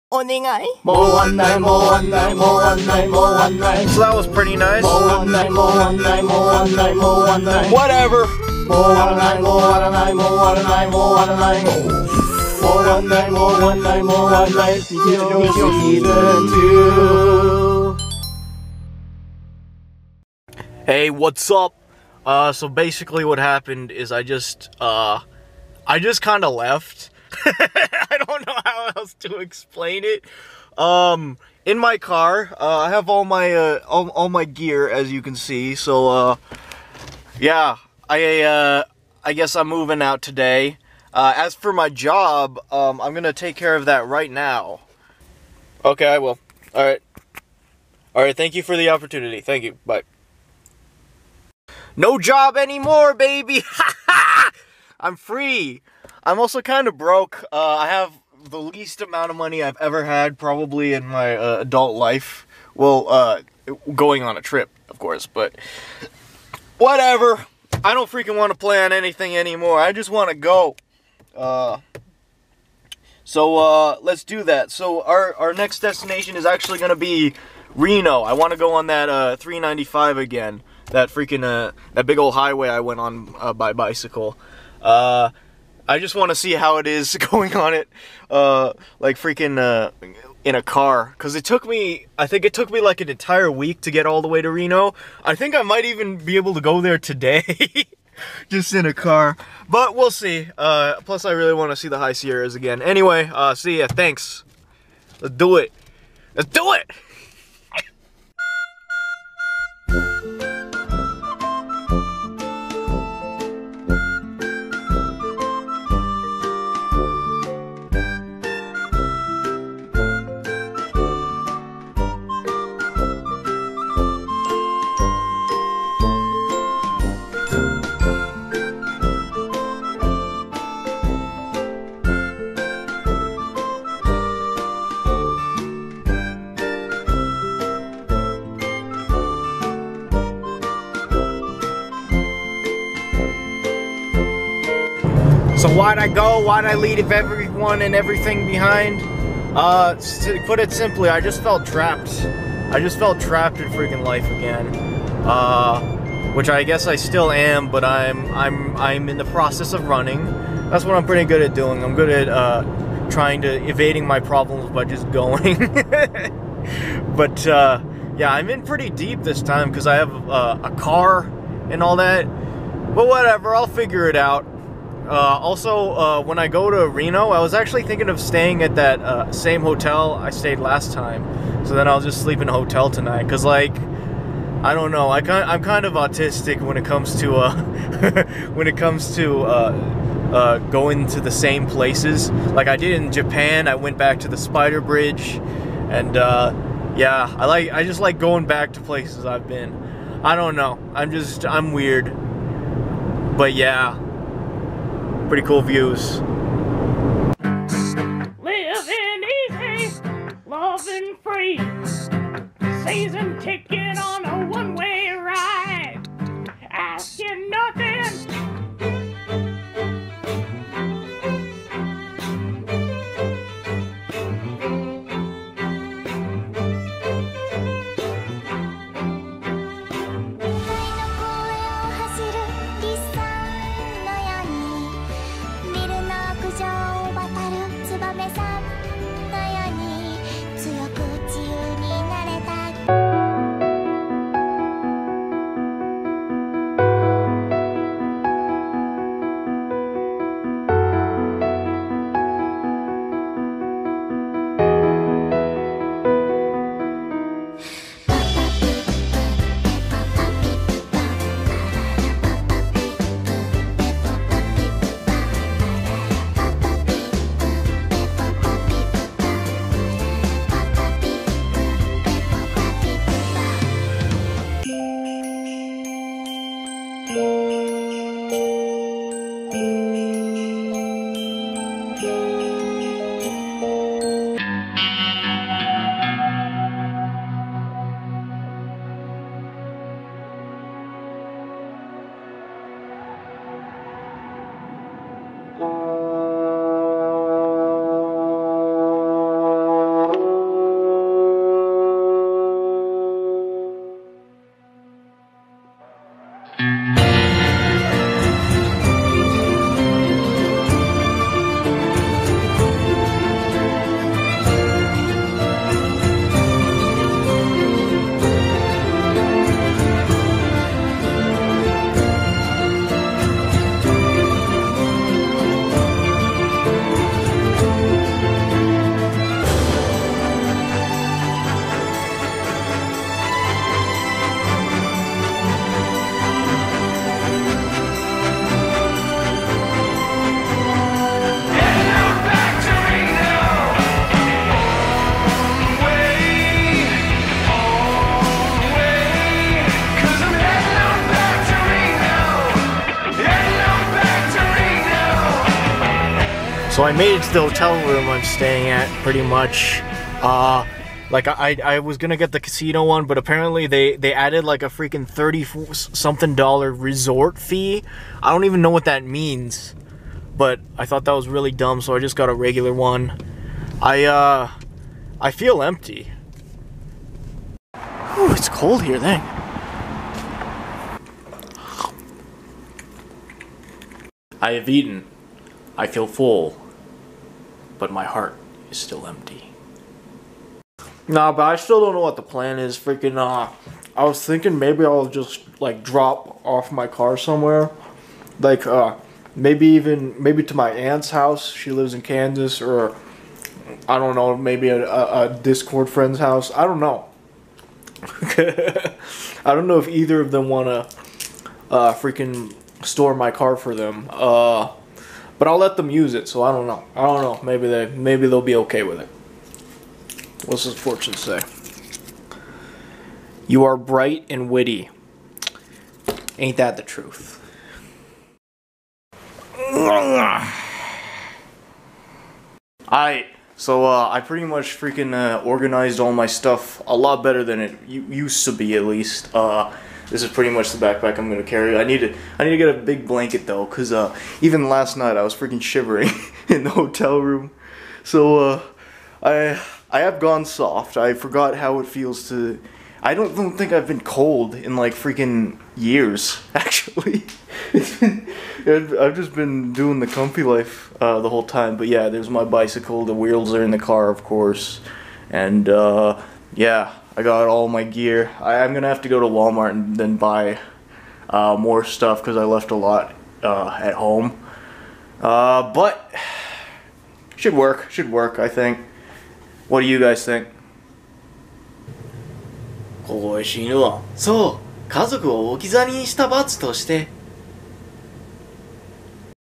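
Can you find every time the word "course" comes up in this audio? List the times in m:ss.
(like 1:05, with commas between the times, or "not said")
1:04, 7:44.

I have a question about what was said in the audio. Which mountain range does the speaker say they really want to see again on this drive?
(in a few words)
High Sierras.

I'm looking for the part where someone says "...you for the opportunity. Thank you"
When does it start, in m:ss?
0:48.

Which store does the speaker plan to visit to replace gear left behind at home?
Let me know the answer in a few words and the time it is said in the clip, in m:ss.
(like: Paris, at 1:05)
Walmart, at 7:49.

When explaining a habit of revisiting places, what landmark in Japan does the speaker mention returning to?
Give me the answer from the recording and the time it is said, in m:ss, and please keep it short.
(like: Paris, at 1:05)
Spider Bridge, at 3:14.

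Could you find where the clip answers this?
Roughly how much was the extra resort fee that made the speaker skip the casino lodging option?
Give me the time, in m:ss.
6:05.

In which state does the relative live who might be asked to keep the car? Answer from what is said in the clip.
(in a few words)
Kansas.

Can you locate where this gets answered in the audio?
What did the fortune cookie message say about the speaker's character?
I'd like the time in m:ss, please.
7:03.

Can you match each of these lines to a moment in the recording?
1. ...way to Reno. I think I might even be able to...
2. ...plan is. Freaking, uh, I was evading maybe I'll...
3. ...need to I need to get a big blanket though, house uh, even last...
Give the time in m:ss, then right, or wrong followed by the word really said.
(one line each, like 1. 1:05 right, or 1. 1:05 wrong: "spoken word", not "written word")
1. 1:34 right
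2. 6:32 wrong: "thinking", not "evading"
3. 7:21 wrong: "cause", not "house".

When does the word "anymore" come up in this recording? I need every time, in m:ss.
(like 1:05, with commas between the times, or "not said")
0:52, 1:09.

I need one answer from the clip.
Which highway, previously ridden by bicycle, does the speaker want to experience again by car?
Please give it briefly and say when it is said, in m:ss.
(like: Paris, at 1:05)
395, at 1:19.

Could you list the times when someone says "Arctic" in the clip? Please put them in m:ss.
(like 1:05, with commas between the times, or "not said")
not said.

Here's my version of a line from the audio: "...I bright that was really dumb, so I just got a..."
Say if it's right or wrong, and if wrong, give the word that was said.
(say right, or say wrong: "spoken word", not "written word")
wrong: "thought", not "bright".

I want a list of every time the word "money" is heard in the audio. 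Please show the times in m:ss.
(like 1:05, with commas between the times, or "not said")
0:59.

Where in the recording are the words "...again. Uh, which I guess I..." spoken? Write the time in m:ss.
2:34.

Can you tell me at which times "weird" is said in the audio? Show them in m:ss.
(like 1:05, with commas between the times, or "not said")
3:21.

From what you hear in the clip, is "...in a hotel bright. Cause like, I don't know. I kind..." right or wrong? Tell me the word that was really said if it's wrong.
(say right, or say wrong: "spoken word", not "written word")
wrong: "tonight", not "bright".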